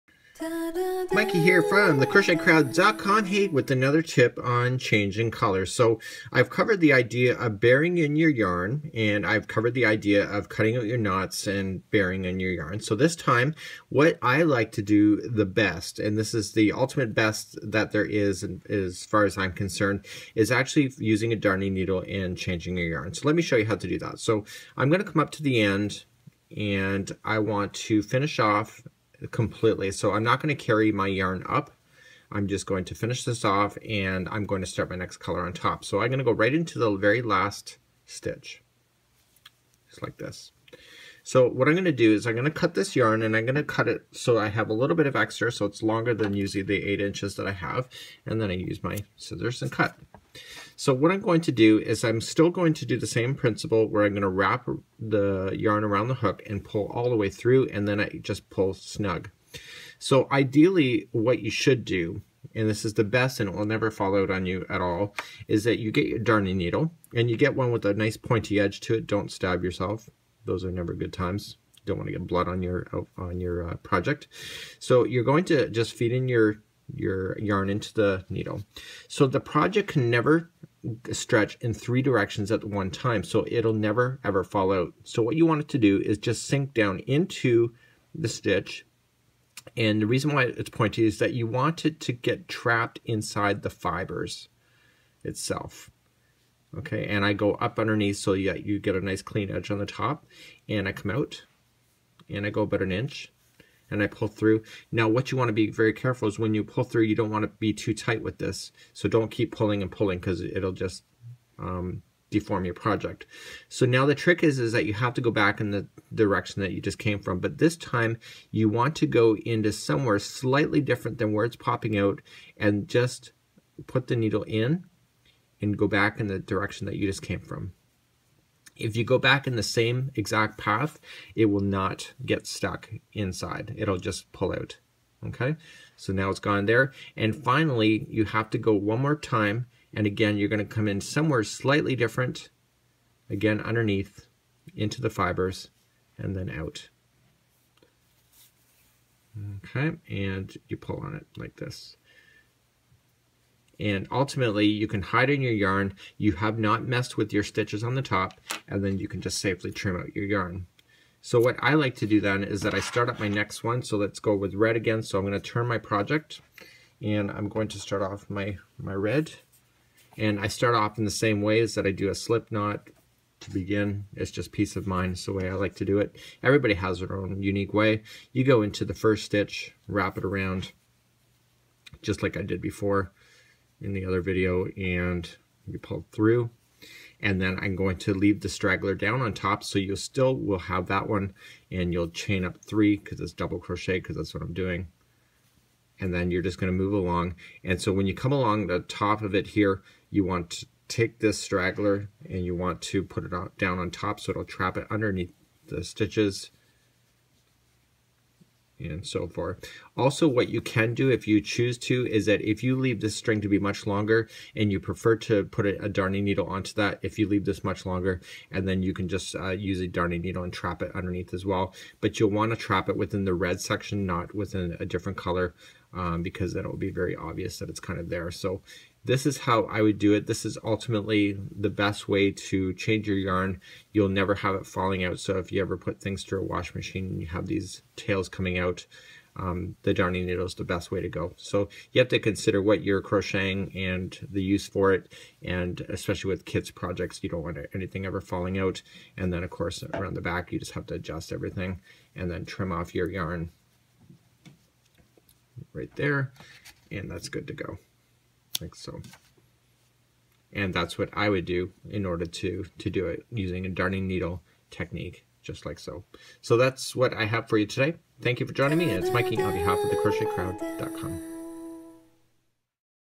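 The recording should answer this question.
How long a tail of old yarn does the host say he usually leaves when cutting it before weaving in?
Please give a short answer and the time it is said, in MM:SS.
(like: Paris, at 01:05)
8 inches, at 00:46.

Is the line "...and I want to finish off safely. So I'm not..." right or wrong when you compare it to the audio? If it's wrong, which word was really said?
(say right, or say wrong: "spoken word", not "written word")
wrong: "completely", not "safely".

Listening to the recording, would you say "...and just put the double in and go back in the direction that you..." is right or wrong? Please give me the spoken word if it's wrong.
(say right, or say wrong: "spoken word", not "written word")
wrong: "needle", not "double".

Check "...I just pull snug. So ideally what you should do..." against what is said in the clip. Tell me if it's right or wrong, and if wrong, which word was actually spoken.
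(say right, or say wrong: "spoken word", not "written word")
right.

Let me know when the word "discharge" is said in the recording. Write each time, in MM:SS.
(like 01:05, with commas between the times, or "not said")
not said.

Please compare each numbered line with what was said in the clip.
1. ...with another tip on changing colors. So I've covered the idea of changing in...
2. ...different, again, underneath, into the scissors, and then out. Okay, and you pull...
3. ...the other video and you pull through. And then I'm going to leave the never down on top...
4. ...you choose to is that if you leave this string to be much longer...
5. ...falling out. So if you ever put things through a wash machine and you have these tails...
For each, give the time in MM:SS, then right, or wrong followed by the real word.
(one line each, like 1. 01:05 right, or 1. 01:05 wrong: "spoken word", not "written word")
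1. 00:03 wrong: "burying", not "changing"
2. 02:21 wrong: "fibers", not "scissors"
3. 03:03 wrong: "straggler", not "never"
4. 03:31 right
5. 03:54 right.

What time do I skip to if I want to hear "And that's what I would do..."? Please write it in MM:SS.
04:20.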